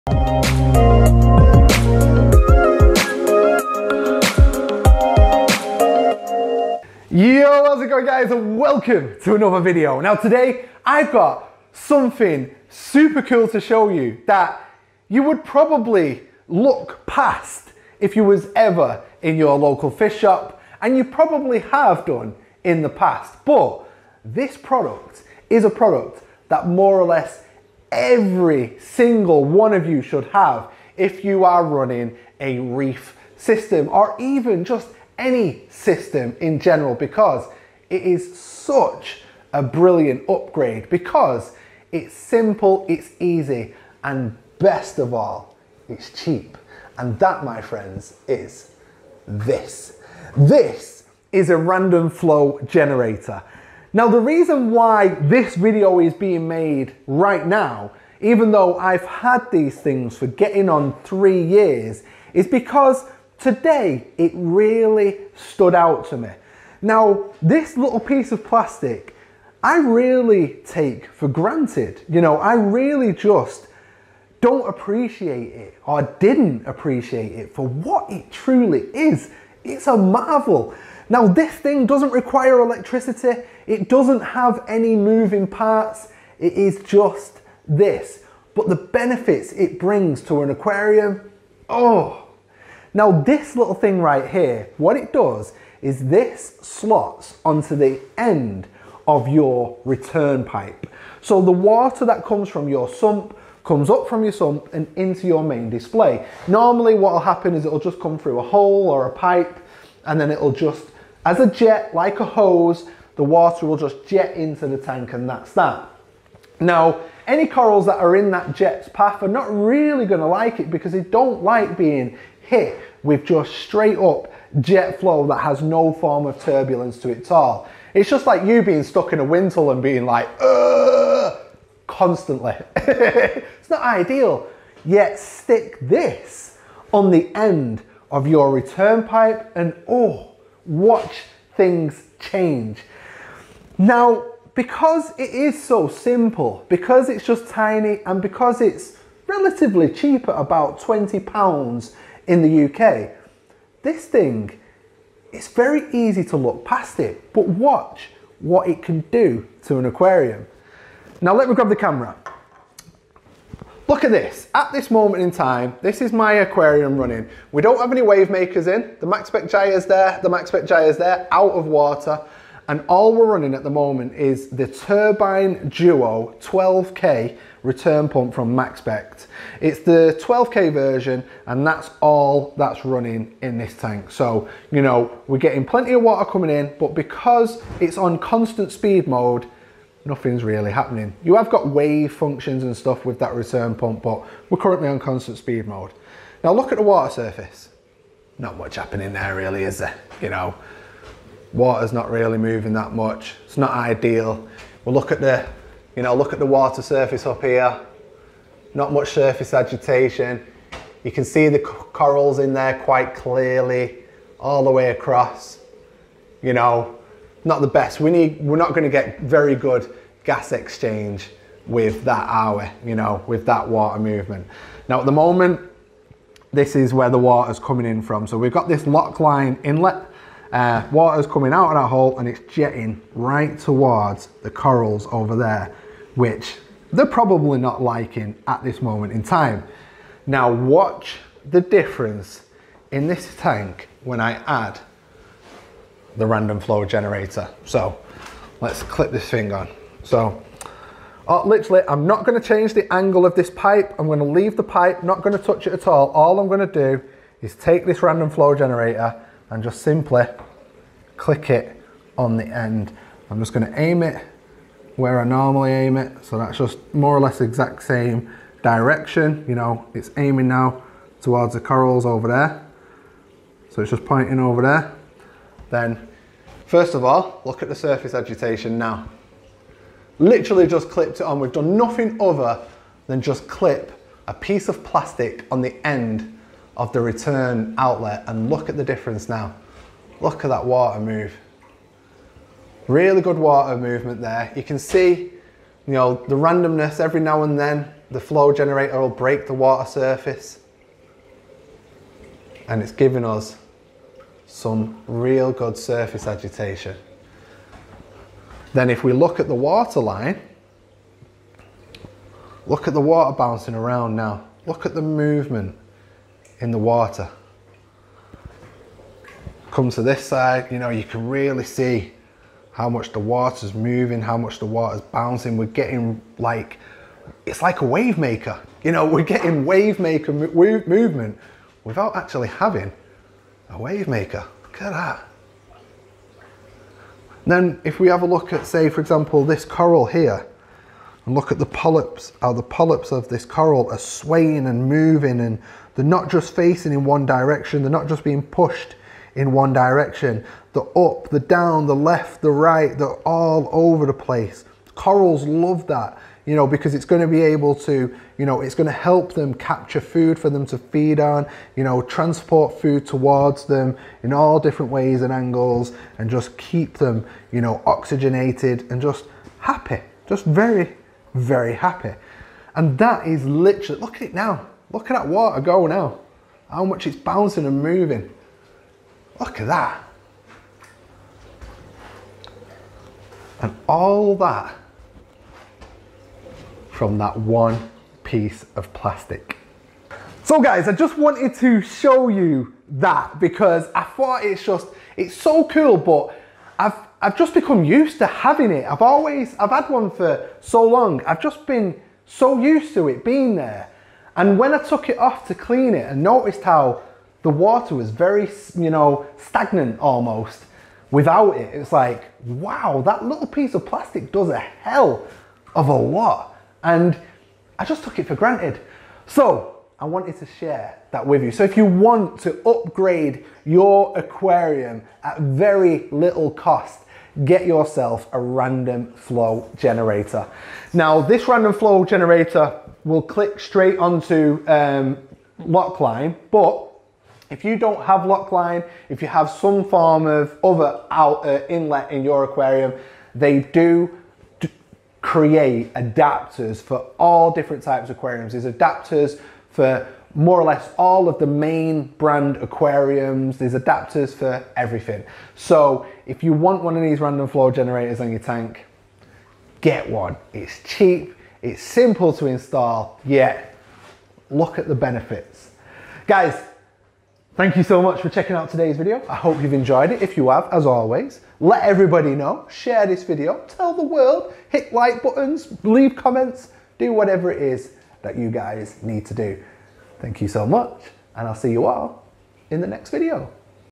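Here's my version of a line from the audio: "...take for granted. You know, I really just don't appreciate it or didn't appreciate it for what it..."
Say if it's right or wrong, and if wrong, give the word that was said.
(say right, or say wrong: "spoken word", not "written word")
right.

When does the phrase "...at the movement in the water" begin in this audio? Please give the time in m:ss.
5:14.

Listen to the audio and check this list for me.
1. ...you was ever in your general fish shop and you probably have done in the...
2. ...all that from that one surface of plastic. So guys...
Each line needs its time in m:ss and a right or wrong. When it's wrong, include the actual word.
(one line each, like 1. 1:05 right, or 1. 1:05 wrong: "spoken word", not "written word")
1. 0:18 wrong: "local", not "general"
2. 6:23 wrong: "piece", not "surface".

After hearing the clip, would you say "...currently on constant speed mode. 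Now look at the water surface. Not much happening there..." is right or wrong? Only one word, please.
right.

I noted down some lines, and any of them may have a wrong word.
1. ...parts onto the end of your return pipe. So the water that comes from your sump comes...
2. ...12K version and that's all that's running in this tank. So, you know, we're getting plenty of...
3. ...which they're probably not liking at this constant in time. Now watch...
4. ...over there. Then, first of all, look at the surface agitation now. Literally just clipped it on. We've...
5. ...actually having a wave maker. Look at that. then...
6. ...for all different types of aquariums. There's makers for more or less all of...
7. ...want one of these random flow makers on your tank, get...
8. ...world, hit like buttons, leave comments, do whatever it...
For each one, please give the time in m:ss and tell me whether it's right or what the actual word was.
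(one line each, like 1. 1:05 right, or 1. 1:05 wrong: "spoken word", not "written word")
1. 1:36 wrong: "slots", not "parts"
2. 3:00 right
3. 3:56 wrong: "moment", not "constant"
4. 4:34 right
5. 5:32 right
6. 7:26 wrong: "adapters", not "makers"
7. 7:36 wrong: "generators", not "makers"
8. 7:54 right.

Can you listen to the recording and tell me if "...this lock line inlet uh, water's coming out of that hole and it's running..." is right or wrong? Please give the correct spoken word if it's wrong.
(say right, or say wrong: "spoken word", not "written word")
wrong: "jetting", not "running".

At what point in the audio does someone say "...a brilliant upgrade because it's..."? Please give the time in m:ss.
0:39.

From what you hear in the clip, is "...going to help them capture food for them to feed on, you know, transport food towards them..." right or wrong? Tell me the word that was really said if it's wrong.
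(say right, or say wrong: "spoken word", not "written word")
right.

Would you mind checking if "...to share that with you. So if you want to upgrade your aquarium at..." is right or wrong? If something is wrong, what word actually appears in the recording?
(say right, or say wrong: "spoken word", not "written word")
right.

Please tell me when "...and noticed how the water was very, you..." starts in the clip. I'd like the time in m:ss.
6:46.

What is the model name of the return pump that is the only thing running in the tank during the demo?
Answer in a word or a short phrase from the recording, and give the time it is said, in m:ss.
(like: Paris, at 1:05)
Turbine Duo 12K, at 2:54.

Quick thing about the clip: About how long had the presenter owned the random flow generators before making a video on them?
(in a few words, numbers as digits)
3 years.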